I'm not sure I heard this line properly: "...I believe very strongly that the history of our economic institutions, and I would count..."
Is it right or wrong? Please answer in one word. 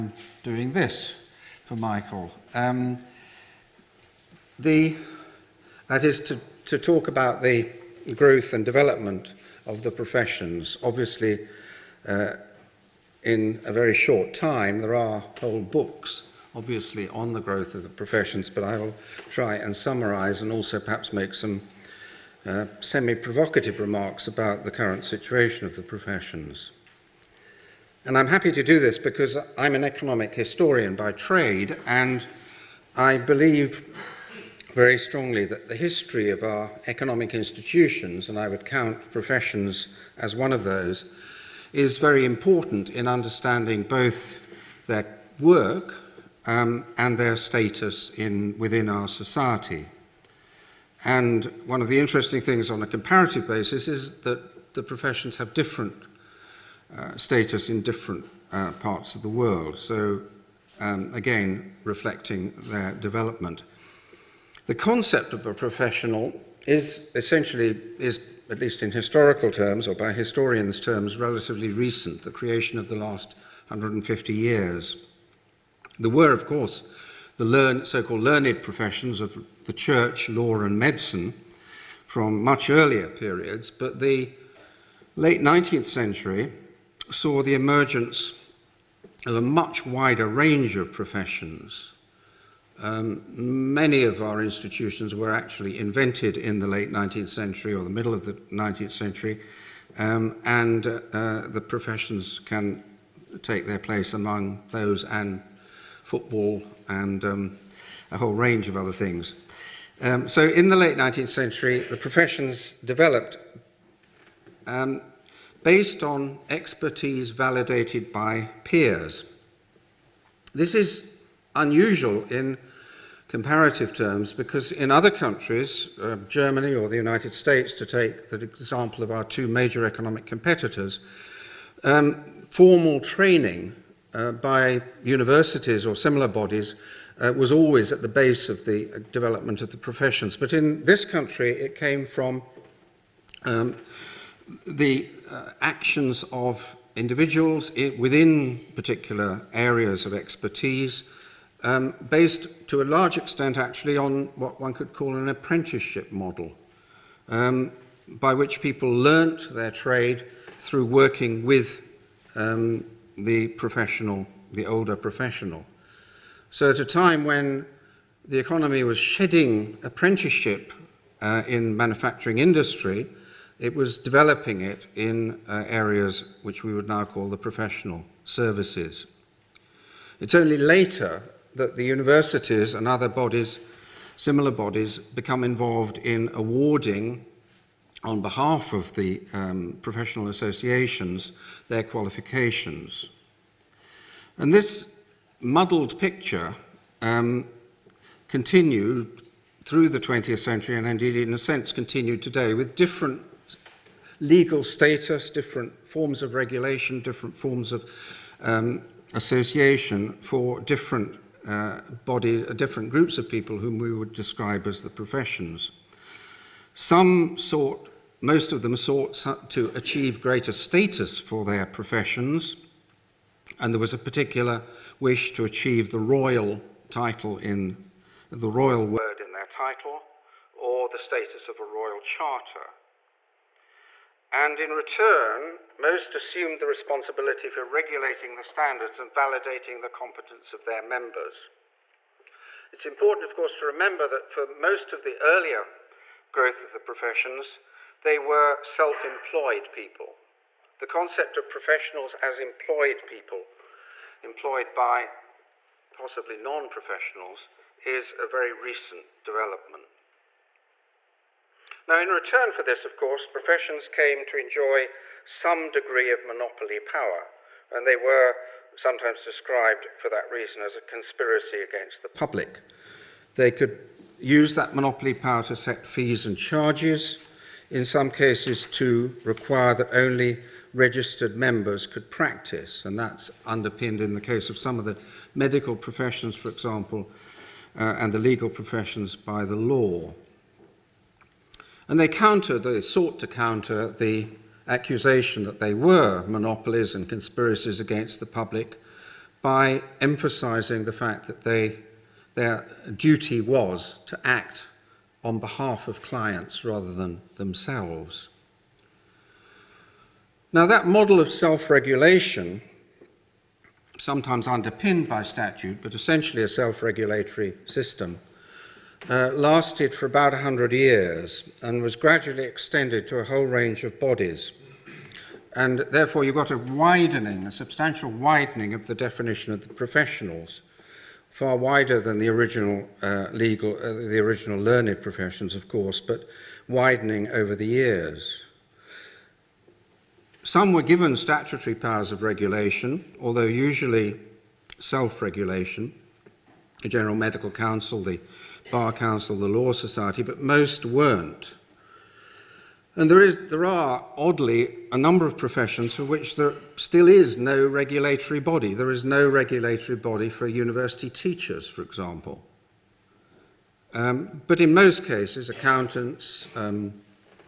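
right.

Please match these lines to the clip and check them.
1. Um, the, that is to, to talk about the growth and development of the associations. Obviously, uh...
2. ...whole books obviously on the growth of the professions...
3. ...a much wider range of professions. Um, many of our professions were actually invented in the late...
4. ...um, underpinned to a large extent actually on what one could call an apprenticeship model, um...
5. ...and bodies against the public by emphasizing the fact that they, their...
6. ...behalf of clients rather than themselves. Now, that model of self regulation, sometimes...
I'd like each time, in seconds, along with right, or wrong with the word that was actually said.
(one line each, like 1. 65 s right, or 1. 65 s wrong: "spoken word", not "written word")
1. 2 s wrong: "professions", not "associations"
2. 15 s right
3. 89 s wrong: "institutions", not "professions"
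4. 151 s wrong: "based", not "underpinned"
5. 296 s wrong: "conspiracies", not "bodies"
6. 305 s right.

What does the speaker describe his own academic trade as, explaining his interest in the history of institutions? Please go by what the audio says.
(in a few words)
Economic historian.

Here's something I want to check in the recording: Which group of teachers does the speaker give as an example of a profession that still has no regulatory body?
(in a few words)
University teachers.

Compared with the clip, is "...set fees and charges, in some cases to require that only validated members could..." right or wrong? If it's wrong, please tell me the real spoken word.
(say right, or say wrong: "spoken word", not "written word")
wrong: "registered", not "validated".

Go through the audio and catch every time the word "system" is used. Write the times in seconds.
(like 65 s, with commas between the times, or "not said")
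317 s.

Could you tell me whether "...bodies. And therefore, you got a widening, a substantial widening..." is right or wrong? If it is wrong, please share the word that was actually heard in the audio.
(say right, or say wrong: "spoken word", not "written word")
right.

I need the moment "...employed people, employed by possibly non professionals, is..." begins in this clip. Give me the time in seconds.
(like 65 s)
252 s.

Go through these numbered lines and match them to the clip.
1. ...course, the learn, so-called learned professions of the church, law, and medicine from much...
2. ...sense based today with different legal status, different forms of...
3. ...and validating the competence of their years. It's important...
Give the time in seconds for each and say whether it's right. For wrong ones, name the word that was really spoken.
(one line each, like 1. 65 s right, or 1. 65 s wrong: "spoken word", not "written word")
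1. 76 s right
2. 201 s wrong: "continued", not "based"
3. 239 s wrong: "members", not "years".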